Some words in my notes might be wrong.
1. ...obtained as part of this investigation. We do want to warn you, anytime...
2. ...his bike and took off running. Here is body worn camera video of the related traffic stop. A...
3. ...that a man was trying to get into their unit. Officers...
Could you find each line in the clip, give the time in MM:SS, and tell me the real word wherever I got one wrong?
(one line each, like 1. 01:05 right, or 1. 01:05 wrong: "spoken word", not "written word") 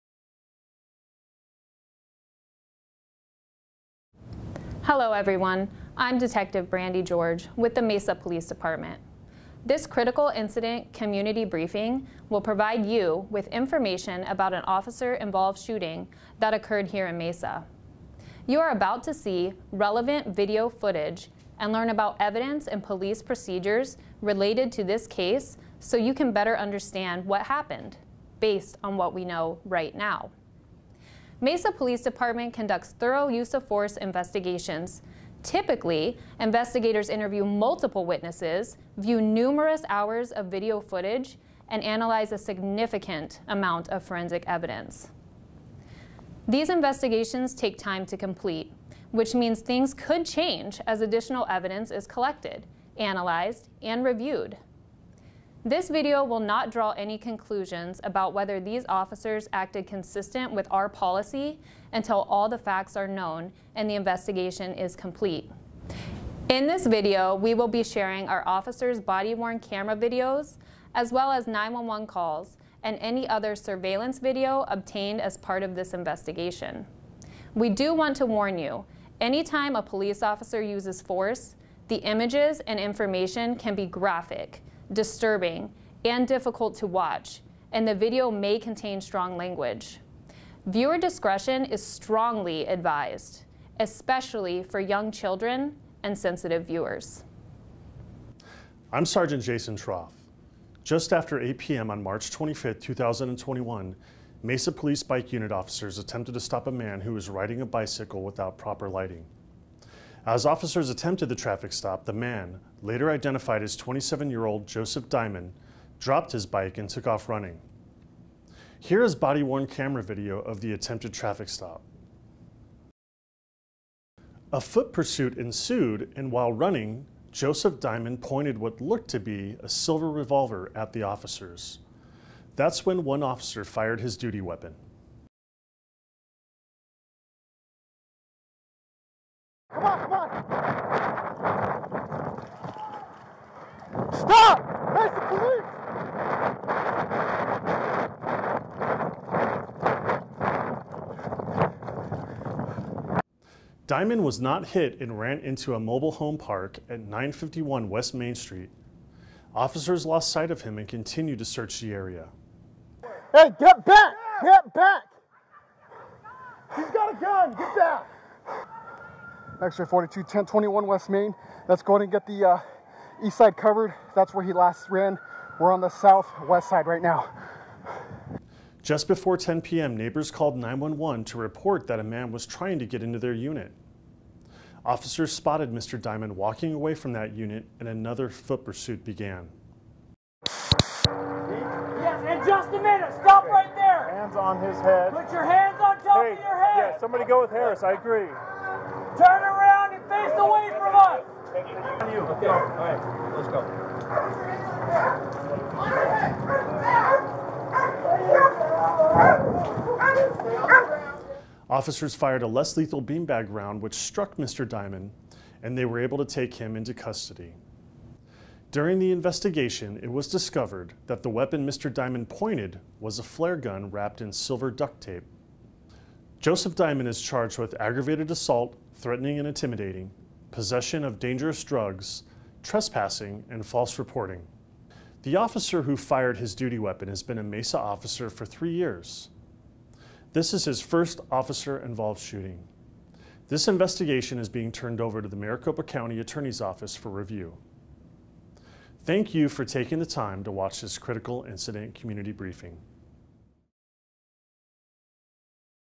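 1. 01:14 right
2. 01:56 wrong: "attempted", not "related"
3. 03:01 right.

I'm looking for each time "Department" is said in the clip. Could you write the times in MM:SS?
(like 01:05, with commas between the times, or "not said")
00:08, 00:32.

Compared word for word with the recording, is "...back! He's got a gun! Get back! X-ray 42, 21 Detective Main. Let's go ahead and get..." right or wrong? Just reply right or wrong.
wrong.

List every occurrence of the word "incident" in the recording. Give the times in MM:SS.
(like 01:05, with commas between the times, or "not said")
00:10, 04:11.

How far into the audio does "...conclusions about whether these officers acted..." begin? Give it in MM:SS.
00:57.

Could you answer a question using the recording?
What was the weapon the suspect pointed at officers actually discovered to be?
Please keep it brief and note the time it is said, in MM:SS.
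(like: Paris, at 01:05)
A flare gun, at 03:43.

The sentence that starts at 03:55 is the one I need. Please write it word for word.
The officer who fired his duty weapon has been a Mesa officer for three years.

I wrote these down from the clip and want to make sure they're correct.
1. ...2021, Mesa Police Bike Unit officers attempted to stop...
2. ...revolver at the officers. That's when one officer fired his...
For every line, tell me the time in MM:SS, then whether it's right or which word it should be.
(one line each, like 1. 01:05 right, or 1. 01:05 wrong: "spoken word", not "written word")
1. 01:42 right
2. 02:10 right.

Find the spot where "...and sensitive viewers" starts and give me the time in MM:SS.
01:36.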